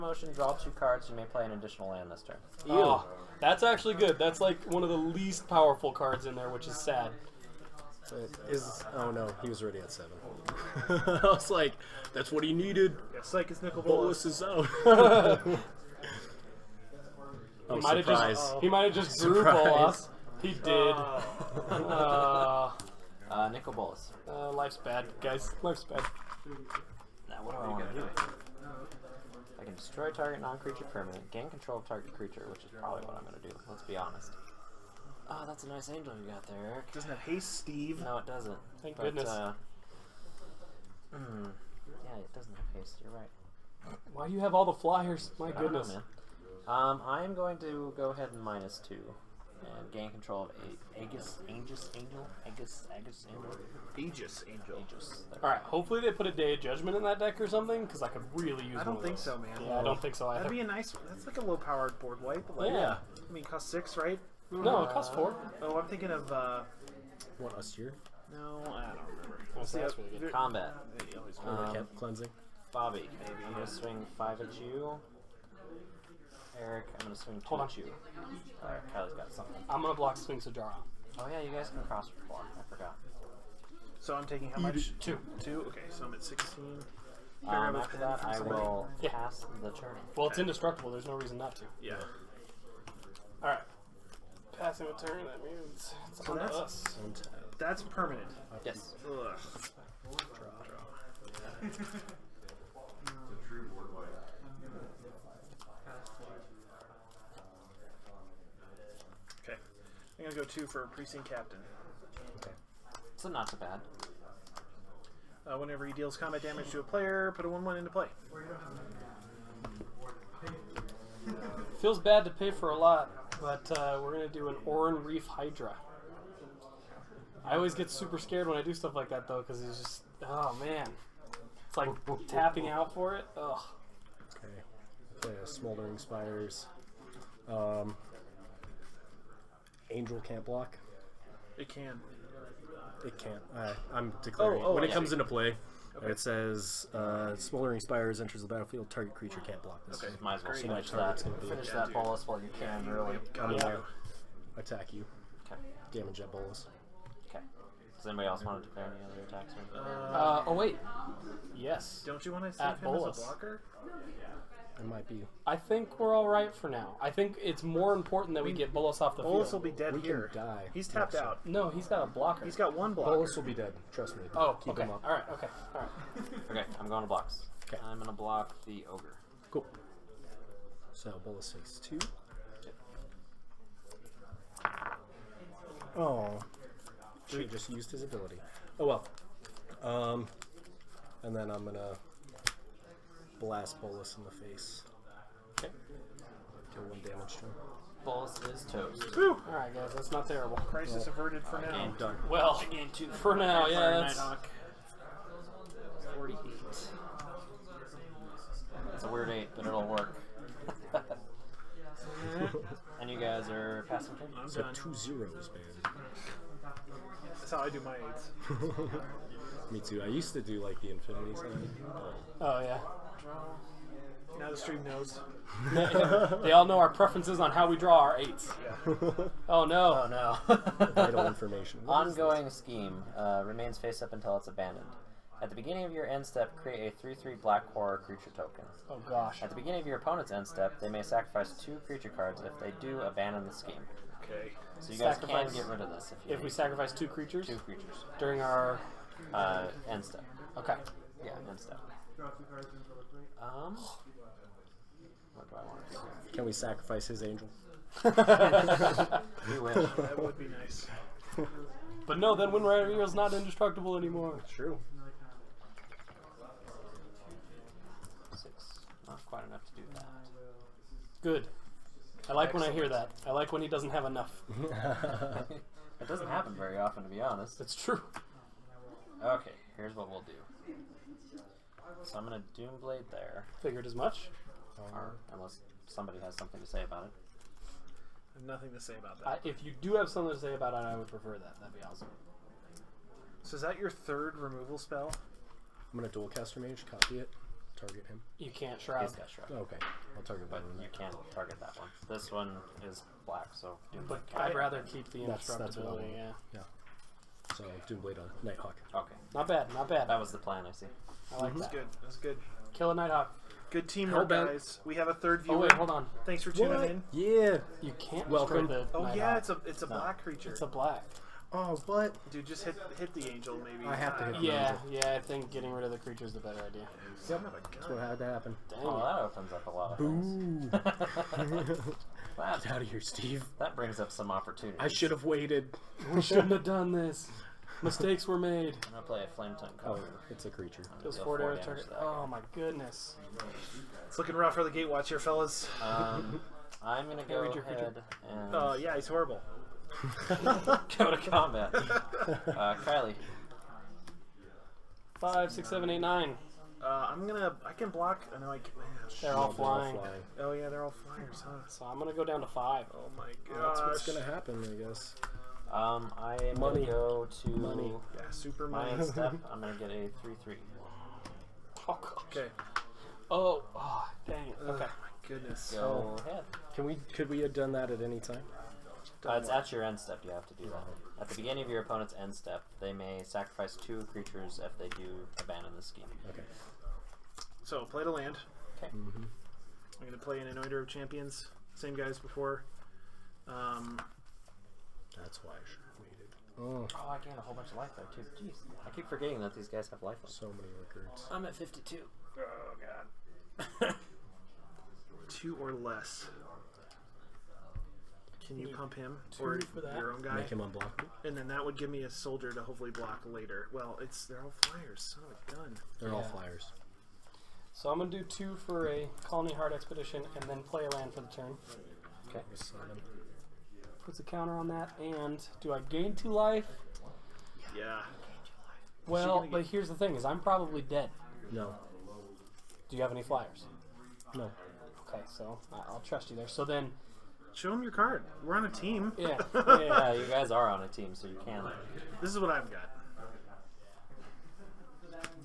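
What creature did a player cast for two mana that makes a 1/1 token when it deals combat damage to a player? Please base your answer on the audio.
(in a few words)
Precinct Captain.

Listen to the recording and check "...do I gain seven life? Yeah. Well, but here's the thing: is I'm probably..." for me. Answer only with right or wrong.
wrong.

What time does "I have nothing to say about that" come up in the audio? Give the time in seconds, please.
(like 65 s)
288 s.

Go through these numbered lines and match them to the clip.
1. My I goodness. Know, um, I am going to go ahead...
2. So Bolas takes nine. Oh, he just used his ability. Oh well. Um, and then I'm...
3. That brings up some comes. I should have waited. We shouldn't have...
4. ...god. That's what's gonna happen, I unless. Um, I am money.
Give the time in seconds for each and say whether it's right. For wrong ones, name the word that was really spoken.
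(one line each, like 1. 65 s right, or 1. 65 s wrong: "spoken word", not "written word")
1. 45 s right
2. 180 s wrong: "two", not "nine"
3. 333 s wrong: "opportunities", not "comes"
4. 363 s wrong: "guess", not "unless".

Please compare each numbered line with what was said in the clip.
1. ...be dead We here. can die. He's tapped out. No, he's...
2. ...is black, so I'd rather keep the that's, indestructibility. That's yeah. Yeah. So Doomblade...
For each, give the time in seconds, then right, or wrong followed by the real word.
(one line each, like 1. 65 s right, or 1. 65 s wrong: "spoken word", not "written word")
1. 169 s right
2. 302 s right.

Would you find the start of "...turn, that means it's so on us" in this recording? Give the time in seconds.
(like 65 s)
95 s.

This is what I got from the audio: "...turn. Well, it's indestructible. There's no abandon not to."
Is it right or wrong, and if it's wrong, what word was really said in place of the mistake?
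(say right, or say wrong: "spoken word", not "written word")
wrong: "reason", not "abandon".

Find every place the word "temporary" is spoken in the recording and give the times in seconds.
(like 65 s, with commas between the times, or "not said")
not said.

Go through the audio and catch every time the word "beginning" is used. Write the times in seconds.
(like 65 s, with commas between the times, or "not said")
235 s, 239 s, 381 s.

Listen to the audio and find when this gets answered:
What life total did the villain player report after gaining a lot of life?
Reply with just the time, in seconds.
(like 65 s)
401 s.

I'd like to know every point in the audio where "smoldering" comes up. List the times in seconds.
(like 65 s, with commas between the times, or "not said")
135 s, 147 s.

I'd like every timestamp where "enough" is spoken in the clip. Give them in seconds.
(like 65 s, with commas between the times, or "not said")
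269 s, 274 s.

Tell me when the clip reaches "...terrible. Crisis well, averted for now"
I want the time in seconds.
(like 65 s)
200 s.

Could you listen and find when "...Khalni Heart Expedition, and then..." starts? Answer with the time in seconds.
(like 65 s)
419 s.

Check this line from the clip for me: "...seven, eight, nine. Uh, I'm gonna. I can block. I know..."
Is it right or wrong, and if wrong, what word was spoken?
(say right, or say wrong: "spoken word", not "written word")
right.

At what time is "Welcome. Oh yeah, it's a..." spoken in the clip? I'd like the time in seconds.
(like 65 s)
318 s.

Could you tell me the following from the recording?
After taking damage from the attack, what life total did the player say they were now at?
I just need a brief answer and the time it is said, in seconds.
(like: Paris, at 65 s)
16, at 86 s.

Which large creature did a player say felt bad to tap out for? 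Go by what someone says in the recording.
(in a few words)
Oran-Rief Hydra.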